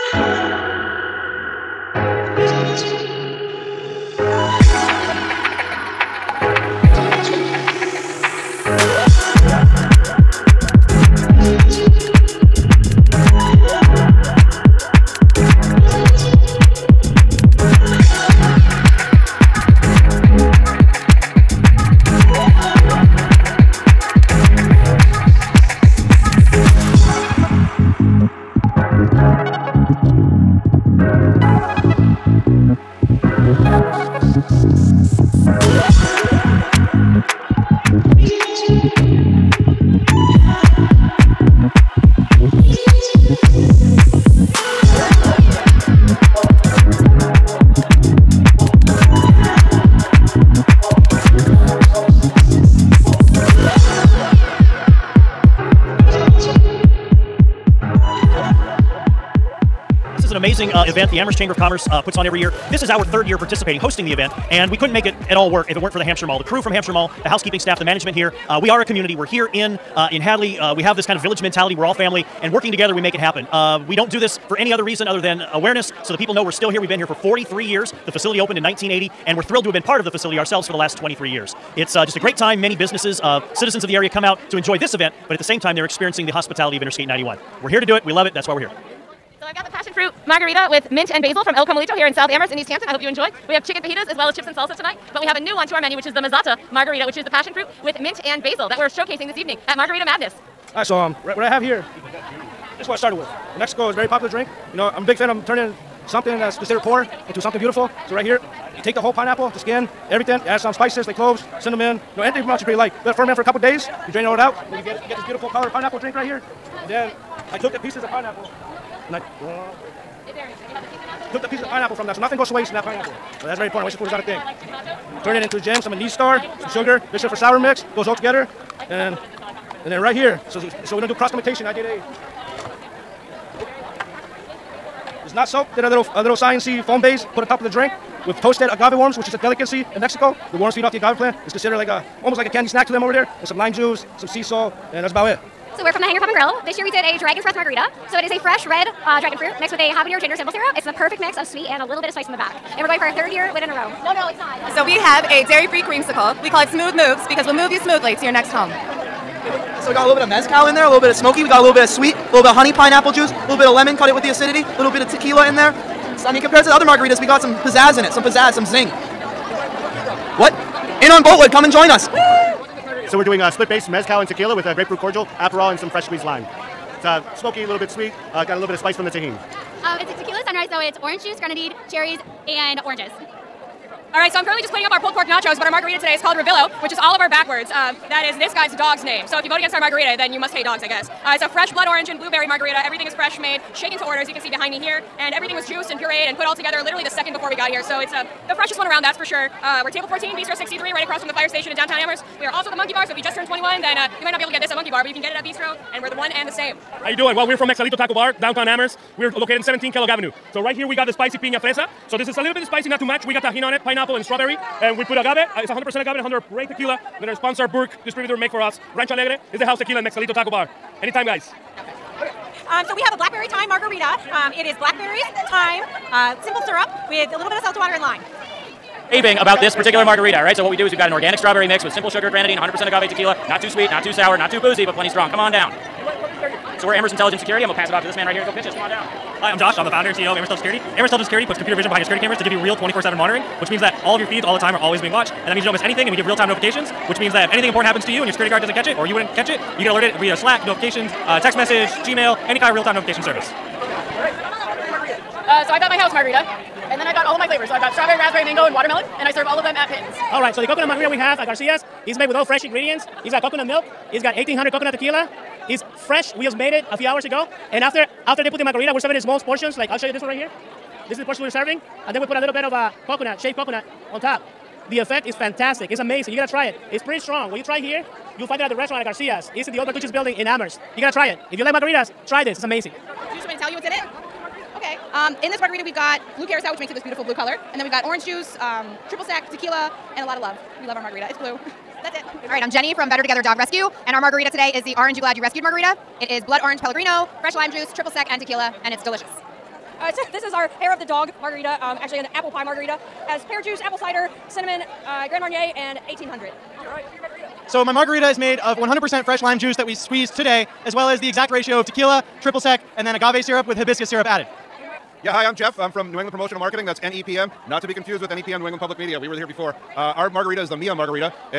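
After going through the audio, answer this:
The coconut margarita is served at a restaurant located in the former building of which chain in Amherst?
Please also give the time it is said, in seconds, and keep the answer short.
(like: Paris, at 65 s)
Bertucci's, at 279 s.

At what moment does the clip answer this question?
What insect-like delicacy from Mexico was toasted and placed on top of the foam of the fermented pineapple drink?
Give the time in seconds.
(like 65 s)
138 s.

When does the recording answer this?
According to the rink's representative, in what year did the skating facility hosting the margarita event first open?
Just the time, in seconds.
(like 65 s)
78 s.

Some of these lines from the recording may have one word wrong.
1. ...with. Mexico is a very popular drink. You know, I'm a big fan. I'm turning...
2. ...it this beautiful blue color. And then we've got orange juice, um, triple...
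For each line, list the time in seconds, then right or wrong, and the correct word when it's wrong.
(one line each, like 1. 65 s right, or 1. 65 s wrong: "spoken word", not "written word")
1. 103 s right
2. 286 s right.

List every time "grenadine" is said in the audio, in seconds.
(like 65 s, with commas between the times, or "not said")
181 s, 232 s.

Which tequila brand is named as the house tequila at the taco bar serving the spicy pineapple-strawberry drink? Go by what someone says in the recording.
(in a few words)
Rancho Alegre.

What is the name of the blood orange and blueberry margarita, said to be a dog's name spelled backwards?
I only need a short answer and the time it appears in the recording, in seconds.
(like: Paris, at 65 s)
Revilo, at 186 s.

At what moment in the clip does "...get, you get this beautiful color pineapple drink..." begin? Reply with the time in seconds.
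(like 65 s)
114 s.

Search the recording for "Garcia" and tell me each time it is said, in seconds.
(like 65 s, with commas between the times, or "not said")
261 s, 279 s.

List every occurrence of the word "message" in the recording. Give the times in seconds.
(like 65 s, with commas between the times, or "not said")
251 s.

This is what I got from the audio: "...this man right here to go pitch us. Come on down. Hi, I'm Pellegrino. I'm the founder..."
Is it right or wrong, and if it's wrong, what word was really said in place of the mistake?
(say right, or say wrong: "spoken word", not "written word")
wrong: "Josh", not "Pellegrino".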